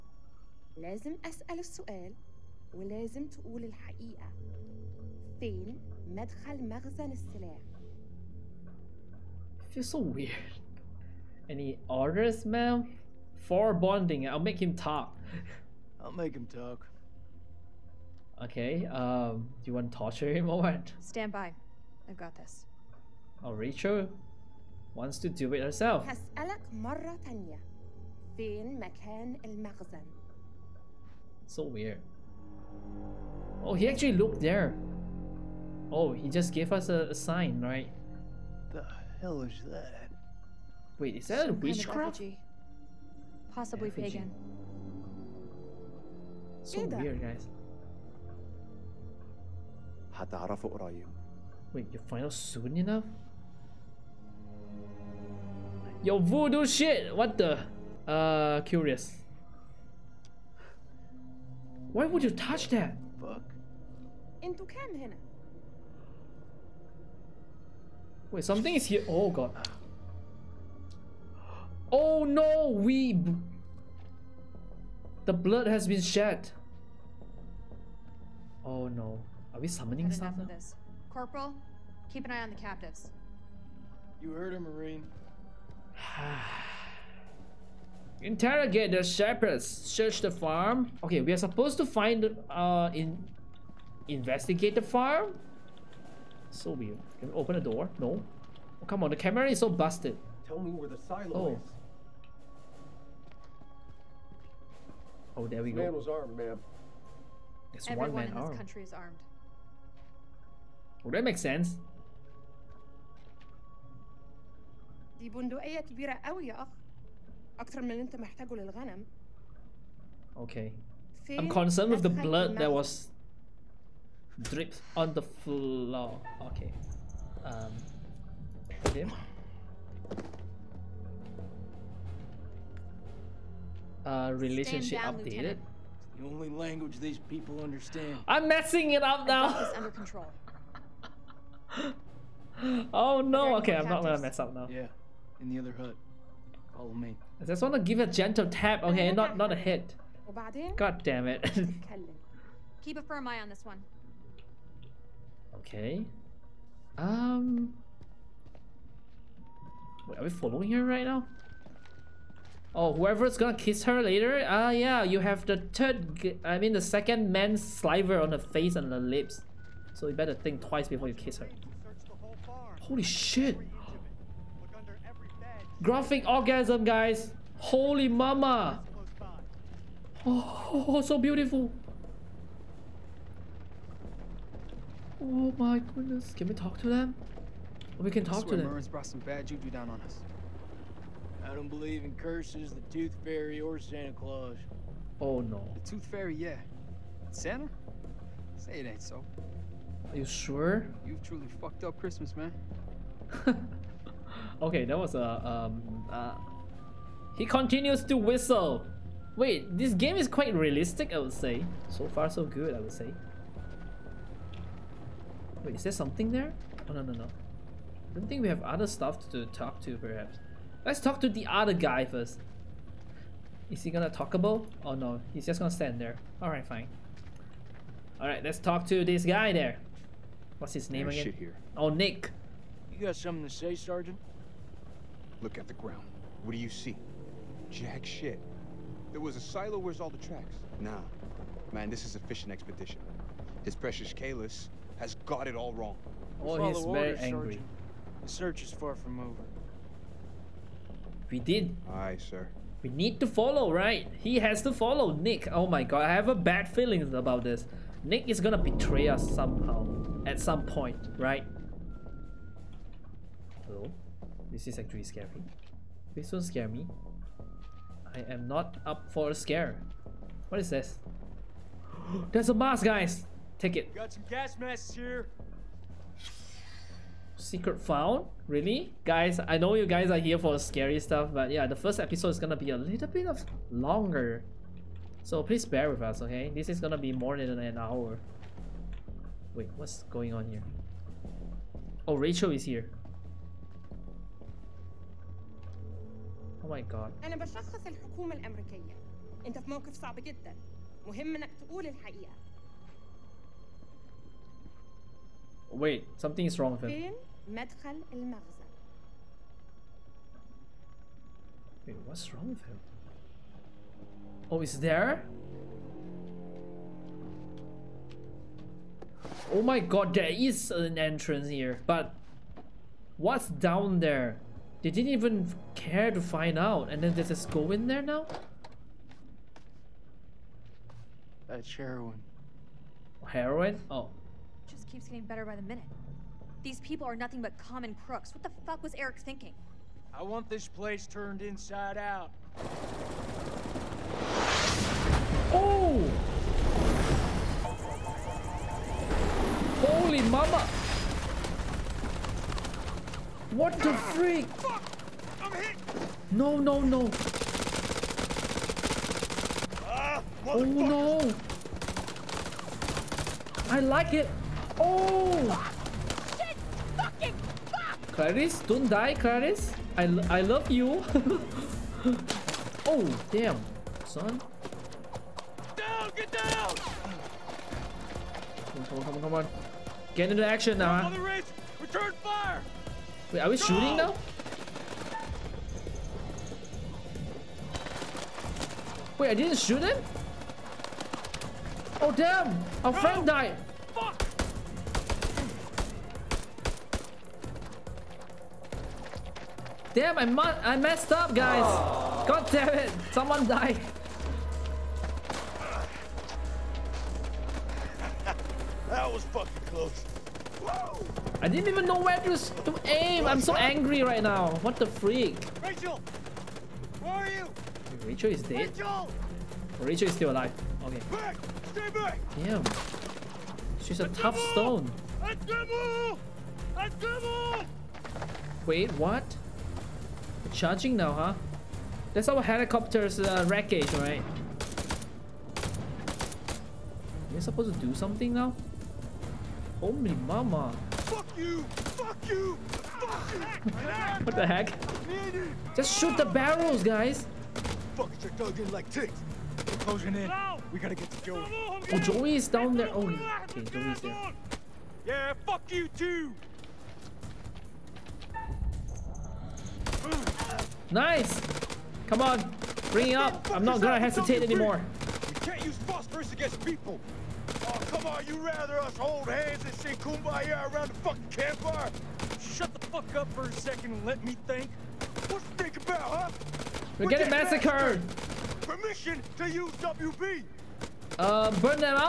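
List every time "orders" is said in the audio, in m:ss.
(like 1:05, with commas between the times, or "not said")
0:11, 4:07.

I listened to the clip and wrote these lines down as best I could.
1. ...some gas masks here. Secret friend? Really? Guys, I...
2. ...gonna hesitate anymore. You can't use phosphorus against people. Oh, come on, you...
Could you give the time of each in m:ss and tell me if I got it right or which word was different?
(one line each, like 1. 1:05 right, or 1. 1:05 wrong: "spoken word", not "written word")
1. 4:34 wrong: "found", not "friend"
2. 7:43 right.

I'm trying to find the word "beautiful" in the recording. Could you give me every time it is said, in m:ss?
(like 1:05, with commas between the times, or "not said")
3:01.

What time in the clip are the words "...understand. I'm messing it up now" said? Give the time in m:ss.
2:17.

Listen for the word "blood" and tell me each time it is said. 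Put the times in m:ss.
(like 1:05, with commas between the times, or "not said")
1:15, 2:02.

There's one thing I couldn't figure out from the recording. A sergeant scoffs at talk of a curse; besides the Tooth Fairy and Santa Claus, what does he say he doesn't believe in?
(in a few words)
curses.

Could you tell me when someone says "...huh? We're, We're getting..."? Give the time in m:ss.
7:55.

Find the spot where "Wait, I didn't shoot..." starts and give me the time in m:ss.
6:29.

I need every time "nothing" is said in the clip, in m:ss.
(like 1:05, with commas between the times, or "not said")
5:37.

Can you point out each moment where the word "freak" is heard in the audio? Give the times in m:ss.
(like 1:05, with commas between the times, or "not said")
5:54, 6:54.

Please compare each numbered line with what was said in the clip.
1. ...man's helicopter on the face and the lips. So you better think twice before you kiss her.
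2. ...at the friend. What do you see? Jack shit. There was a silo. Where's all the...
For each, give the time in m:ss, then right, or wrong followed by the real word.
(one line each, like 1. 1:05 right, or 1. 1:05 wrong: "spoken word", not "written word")
1. 2:47 wrong: "sliver", not "helicopter"
2. 3:55 wrong: "ground", not "friend".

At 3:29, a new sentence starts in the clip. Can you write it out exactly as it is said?
Wait, this game is quite realistic, I would say.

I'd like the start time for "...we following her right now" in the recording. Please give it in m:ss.
2:40.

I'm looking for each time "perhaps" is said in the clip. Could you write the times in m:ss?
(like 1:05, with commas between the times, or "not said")
3:39.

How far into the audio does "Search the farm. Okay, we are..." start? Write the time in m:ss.
1:29.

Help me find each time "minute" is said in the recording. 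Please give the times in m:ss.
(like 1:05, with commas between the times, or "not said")
5:35.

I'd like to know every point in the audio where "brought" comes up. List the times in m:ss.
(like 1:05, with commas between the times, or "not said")
3:08.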